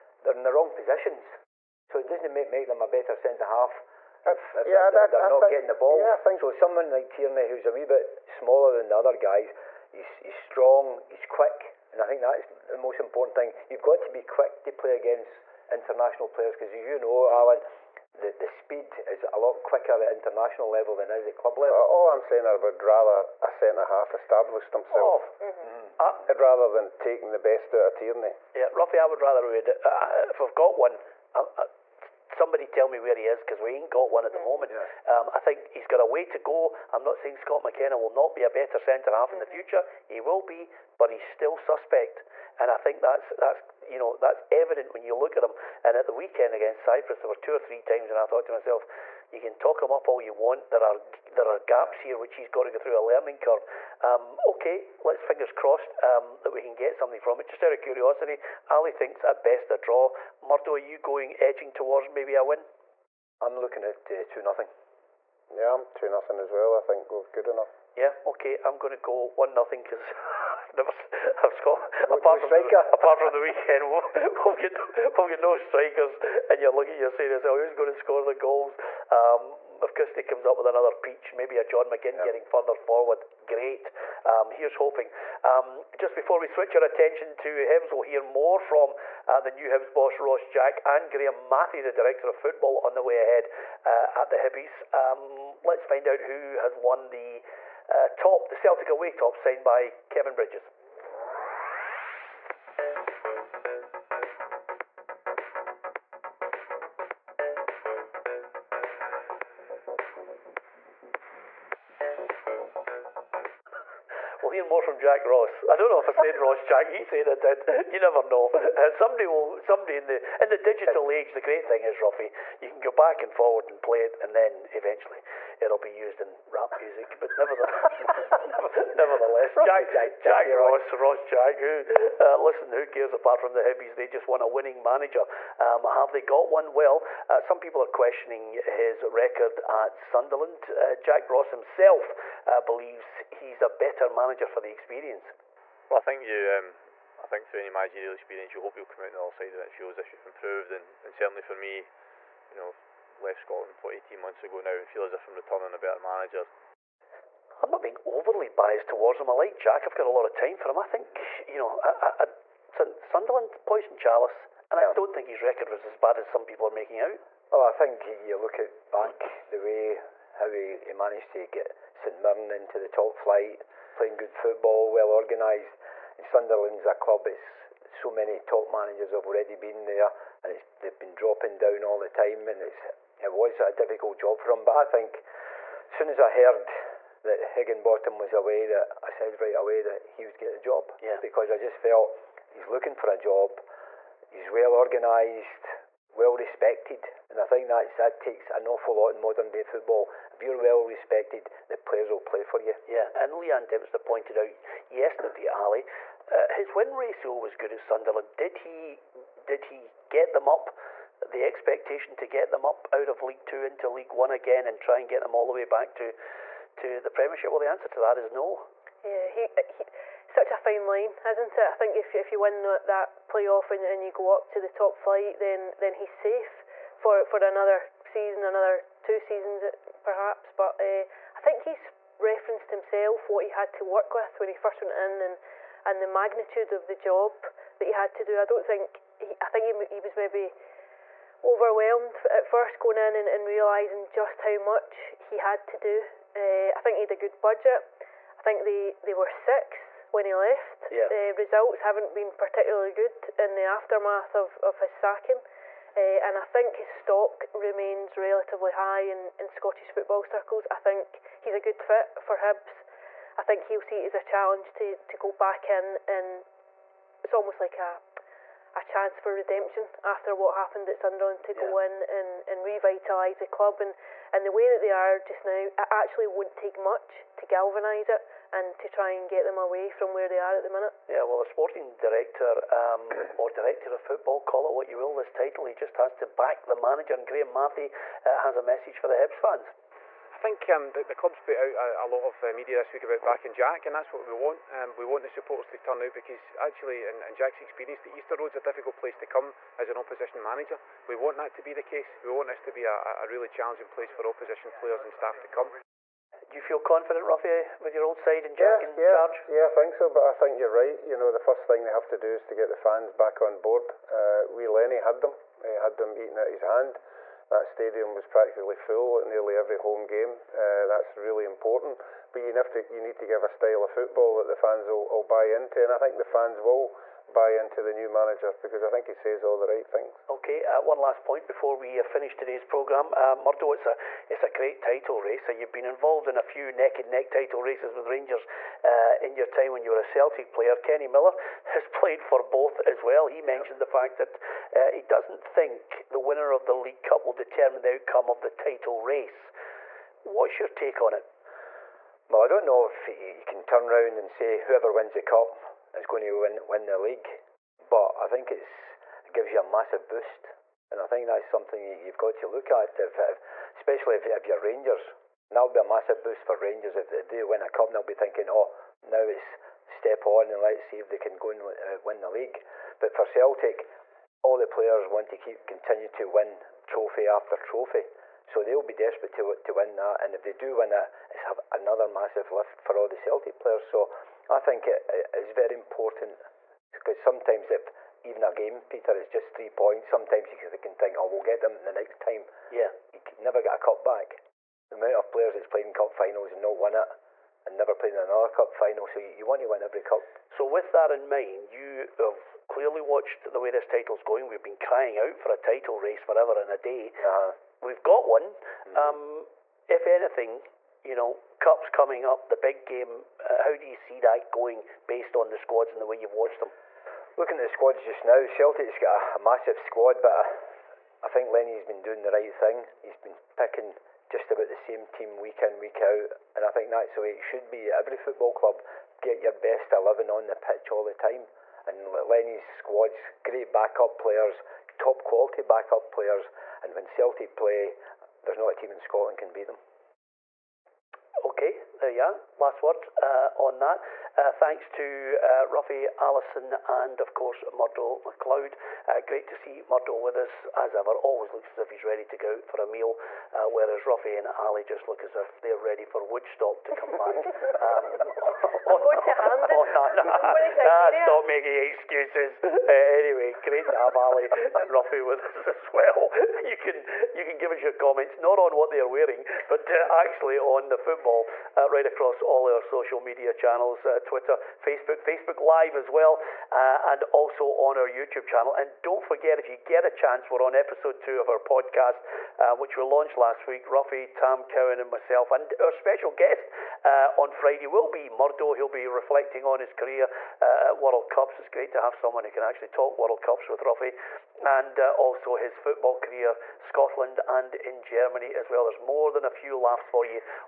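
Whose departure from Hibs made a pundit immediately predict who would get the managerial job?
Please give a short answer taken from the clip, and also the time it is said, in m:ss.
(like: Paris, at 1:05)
Heckingbottom, at 3:07.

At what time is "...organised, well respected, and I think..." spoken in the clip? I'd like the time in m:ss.
3:14.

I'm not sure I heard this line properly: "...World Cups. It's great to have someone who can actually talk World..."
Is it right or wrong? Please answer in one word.
right.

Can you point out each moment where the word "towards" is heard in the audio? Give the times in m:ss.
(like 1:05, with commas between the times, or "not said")
1:01, 2:38.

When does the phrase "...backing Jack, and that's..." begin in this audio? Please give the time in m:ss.
4:53.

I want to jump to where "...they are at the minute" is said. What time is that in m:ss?
4:40.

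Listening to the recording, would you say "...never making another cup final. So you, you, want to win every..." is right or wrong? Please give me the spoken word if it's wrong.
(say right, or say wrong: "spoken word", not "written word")
wrong: "playing", not "making".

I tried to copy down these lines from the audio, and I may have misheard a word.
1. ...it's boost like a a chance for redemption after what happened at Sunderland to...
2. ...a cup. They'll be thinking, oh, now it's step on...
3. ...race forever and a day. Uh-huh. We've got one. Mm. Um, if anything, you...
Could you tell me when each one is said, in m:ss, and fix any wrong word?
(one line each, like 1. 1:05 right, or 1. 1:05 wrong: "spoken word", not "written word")
1. 4:27 wrong: "almost", not "boost"
2. 6:07 right
3. 6:45 right.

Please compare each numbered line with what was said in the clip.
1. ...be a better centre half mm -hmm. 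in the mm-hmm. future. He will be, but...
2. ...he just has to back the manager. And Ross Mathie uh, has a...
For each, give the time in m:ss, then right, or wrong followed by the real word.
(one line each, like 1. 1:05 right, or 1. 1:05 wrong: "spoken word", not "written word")
1. 0:38 right
2. 4:45 wrong: "Graeme", not "Ross".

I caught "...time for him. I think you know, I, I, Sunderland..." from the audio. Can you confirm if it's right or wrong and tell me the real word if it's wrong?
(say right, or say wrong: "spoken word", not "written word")
right.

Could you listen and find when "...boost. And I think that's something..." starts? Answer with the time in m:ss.
6:00.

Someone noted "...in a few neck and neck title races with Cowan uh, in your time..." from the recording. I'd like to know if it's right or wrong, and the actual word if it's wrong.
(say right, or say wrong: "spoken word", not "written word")
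wrong: "Rangers", not "Cowan".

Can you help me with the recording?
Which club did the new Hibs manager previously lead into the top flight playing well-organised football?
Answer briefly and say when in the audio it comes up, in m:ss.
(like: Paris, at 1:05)
St Mirren, at 2:51.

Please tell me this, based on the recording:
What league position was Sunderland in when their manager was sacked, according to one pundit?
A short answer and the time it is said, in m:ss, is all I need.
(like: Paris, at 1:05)
Sixth, at 4:09.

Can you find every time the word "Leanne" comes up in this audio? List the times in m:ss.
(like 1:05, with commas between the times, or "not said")
3:23.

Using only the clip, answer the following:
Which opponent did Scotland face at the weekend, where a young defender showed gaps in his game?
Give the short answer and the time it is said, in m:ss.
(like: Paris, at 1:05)
Cyprus, at 0:46.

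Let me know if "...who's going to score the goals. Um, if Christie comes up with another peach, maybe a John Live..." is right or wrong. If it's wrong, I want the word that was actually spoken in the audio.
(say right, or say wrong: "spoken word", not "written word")
wrong: "McGinn", not "Live".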